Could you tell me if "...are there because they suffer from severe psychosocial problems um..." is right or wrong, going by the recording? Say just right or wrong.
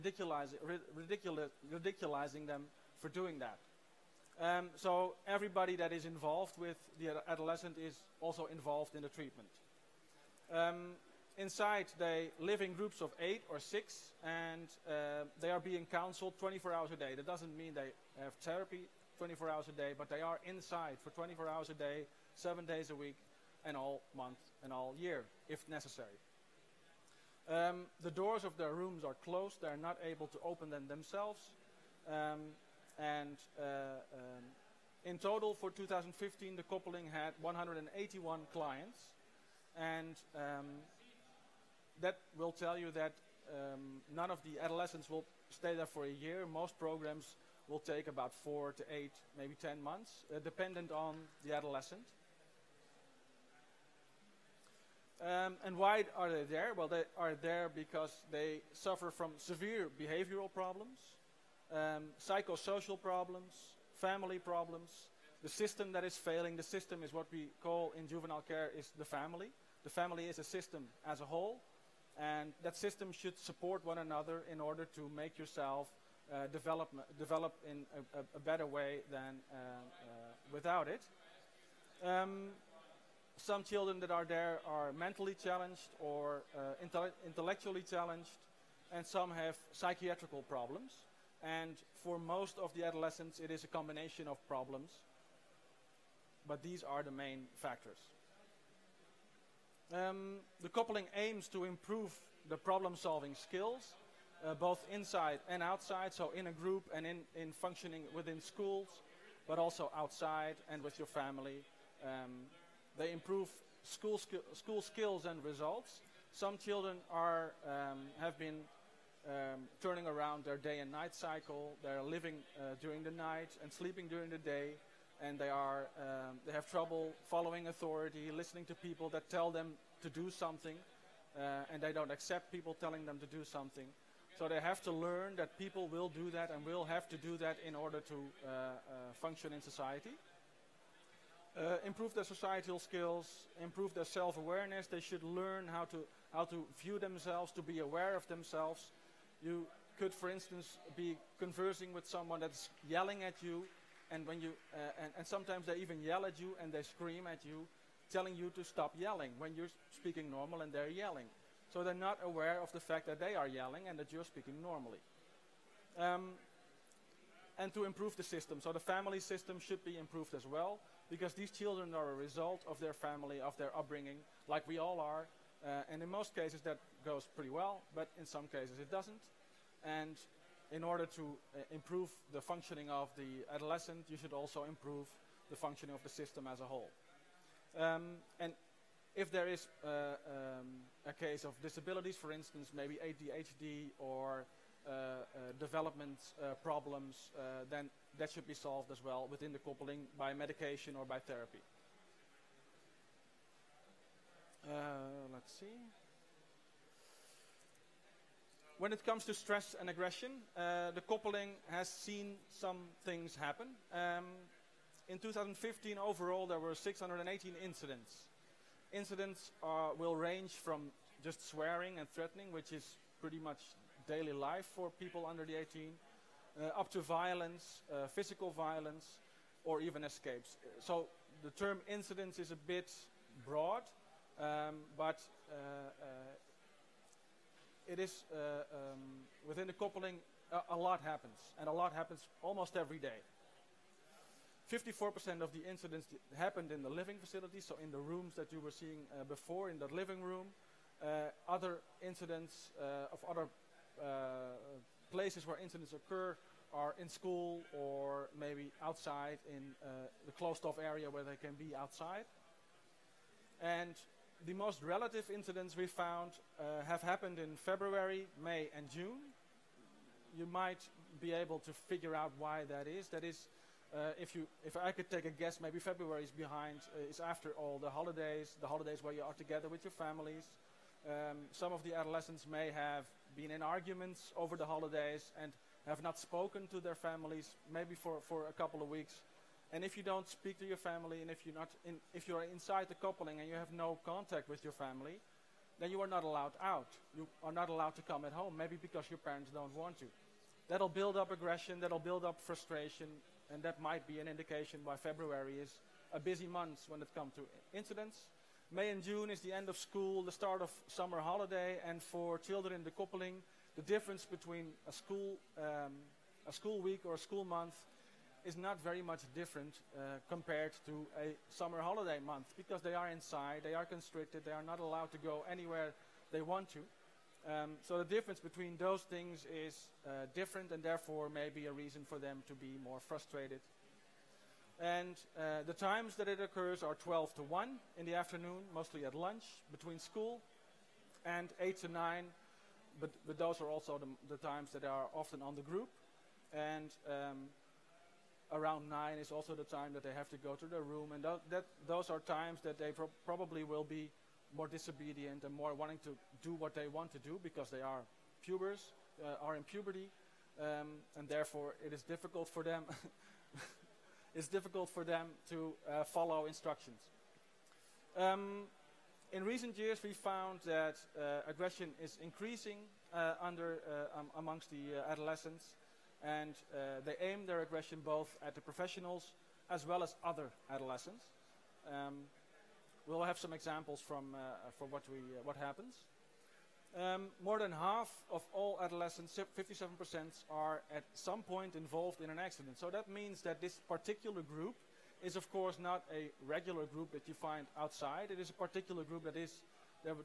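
wrong.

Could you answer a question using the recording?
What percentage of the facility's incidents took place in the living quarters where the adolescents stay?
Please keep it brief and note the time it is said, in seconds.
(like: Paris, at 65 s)
54%, at 244 s.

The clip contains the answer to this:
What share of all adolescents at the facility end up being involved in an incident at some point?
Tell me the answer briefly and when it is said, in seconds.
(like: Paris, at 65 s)
57%, at 389 s.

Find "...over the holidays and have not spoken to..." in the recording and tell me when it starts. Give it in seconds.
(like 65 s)
284 s.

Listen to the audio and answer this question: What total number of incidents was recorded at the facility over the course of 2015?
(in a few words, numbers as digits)
618.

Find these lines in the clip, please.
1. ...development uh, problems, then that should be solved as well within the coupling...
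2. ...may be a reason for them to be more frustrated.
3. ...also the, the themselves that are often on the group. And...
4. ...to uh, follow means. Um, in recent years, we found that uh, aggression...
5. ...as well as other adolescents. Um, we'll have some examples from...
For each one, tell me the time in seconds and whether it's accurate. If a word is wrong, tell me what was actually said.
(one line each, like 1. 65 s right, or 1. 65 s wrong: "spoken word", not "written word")
1. 195 s right
2. 331 s right
3. 343 s wrong: "times", not "themselves"
4. 365 s wrong: "instructions", not "means"
5. 379 s right.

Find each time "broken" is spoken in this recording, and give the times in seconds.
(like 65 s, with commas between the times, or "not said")
not said.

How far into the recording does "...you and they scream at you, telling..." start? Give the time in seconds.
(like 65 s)
156 s.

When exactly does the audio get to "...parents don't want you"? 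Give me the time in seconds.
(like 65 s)
299 s.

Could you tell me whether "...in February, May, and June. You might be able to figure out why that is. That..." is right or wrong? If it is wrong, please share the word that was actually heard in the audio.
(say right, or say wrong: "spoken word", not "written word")
right.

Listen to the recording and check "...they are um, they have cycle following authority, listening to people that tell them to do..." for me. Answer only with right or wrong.
wrong.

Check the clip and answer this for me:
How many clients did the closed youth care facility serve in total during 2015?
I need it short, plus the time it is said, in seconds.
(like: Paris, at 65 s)
181, at 37 s.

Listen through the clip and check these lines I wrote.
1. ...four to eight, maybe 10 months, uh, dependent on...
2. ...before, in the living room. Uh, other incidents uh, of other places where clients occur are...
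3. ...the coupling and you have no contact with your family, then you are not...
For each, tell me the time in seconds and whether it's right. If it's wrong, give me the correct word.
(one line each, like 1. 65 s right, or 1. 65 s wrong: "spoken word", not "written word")
1. 48 s right
2. 249 s wrong: "incidents", not "clients"
3. 292 s right.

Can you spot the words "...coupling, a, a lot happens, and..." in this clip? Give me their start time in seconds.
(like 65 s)
239 s.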